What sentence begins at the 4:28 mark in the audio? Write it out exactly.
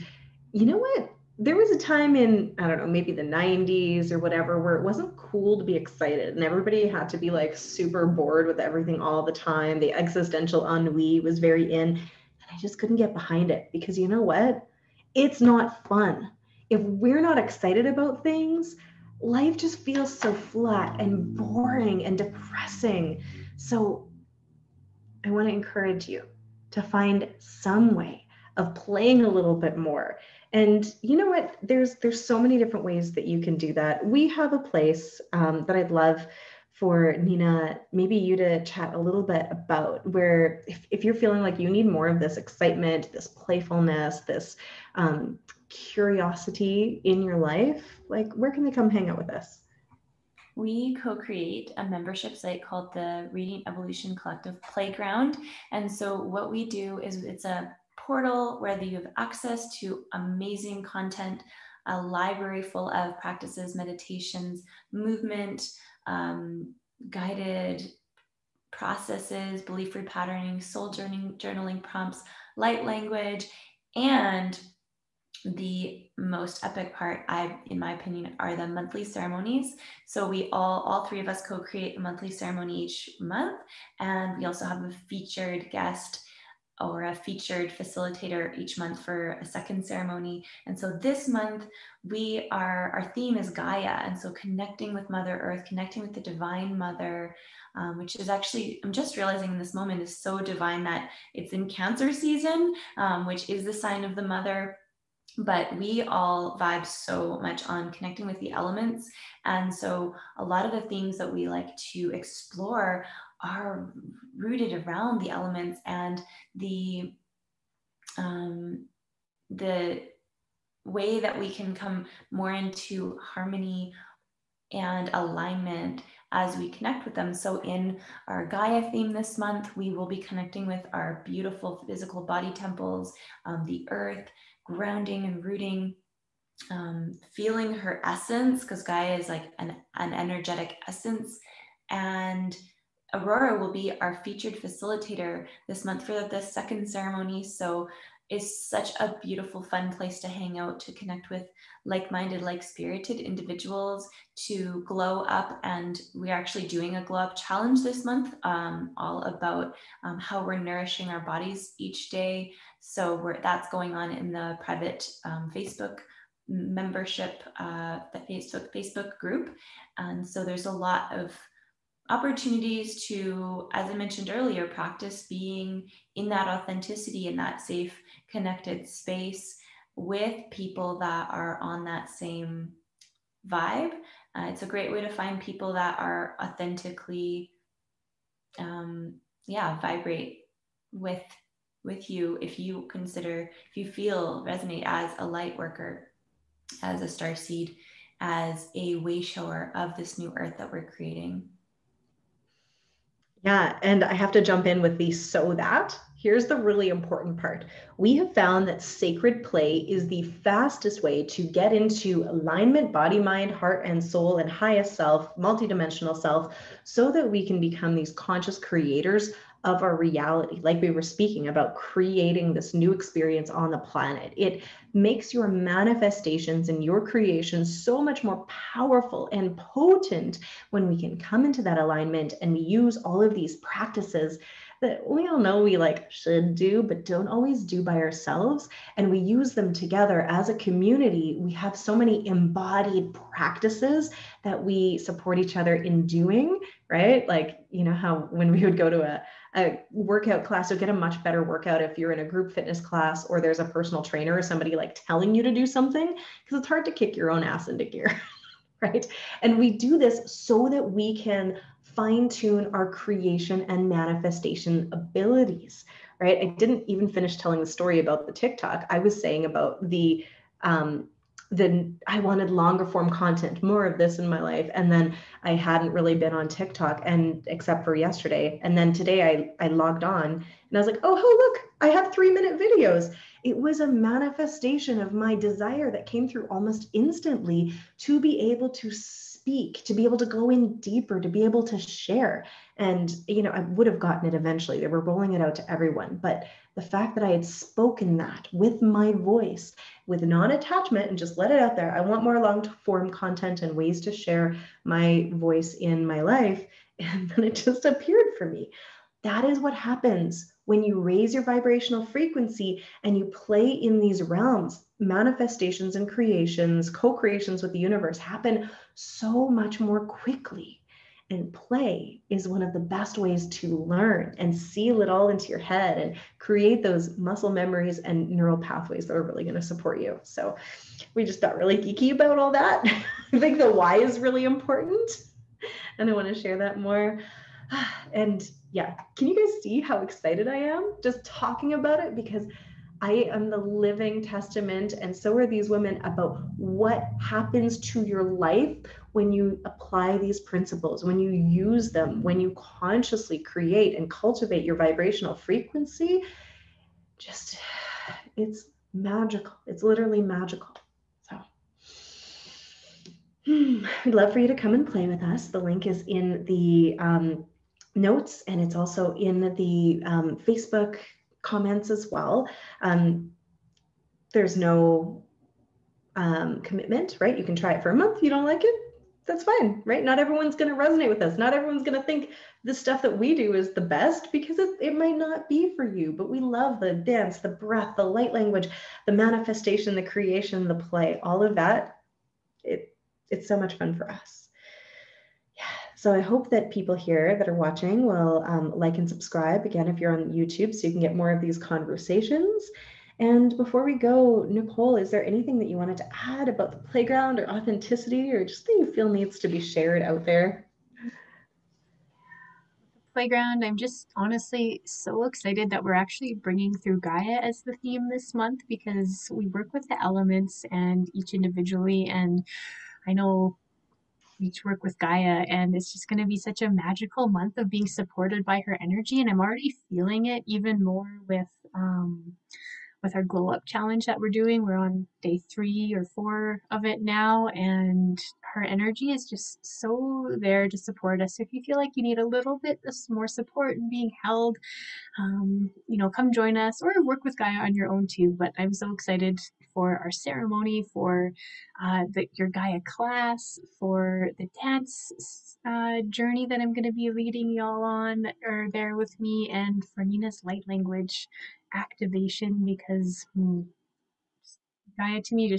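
I was saying about the, um, then I wanted longer form content, more of this in my life.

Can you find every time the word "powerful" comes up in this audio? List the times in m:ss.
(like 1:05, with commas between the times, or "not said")
3:48.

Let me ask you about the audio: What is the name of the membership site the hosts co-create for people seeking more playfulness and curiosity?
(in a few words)
Radiant Evolution Collective Playground.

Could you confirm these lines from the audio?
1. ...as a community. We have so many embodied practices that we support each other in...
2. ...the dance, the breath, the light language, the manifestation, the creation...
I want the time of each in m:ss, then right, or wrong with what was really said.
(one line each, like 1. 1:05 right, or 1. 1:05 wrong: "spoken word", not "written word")
1. 4:00 right
2. 6:26 right.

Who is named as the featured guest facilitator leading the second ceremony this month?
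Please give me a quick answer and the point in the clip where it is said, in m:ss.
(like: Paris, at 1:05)
Aurora, at 2:23.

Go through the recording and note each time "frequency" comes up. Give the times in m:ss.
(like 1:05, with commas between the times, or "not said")
5:12, 5:55.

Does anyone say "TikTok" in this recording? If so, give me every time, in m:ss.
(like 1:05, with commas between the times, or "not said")
4:28, 4:36.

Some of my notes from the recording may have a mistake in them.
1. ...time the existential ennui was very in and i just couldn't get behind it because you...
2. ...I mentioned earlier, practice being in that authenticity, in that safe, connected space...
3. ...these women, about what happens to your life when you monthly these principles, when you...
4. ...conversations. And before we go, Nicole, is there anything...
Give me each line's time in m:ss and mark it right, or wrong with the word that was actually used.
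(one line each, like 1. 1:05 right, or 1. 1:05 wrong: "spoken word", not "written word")
1. 0:09 right
2. 2:53 right
3. 5:45 wrong: "apply", not "monthly"
4. 6:41 right.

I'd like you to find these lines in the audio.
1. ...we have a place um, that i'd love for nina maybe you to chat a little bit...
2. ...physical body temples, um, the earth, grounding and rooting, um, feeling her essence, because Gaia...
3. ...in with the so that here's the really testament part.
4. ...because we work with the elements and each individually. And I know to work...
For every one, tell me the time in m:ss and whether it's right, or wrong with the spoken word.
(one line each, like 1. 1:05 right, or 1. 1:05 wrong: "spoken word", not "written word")
1. 0:34 right
2. 2:11 right
3. 3:24 wrong: "important", not "testament"
4. 6:58 right.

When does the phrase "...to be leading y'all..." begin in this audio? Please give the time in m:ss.
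7:36.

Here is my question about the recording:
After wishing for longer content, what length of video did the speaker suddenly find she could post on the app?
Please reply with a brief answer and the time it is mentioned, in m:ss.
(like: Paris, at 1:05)
3 minutes, at 4:42.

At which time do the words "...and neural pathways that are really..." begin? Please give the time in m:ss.
5:27.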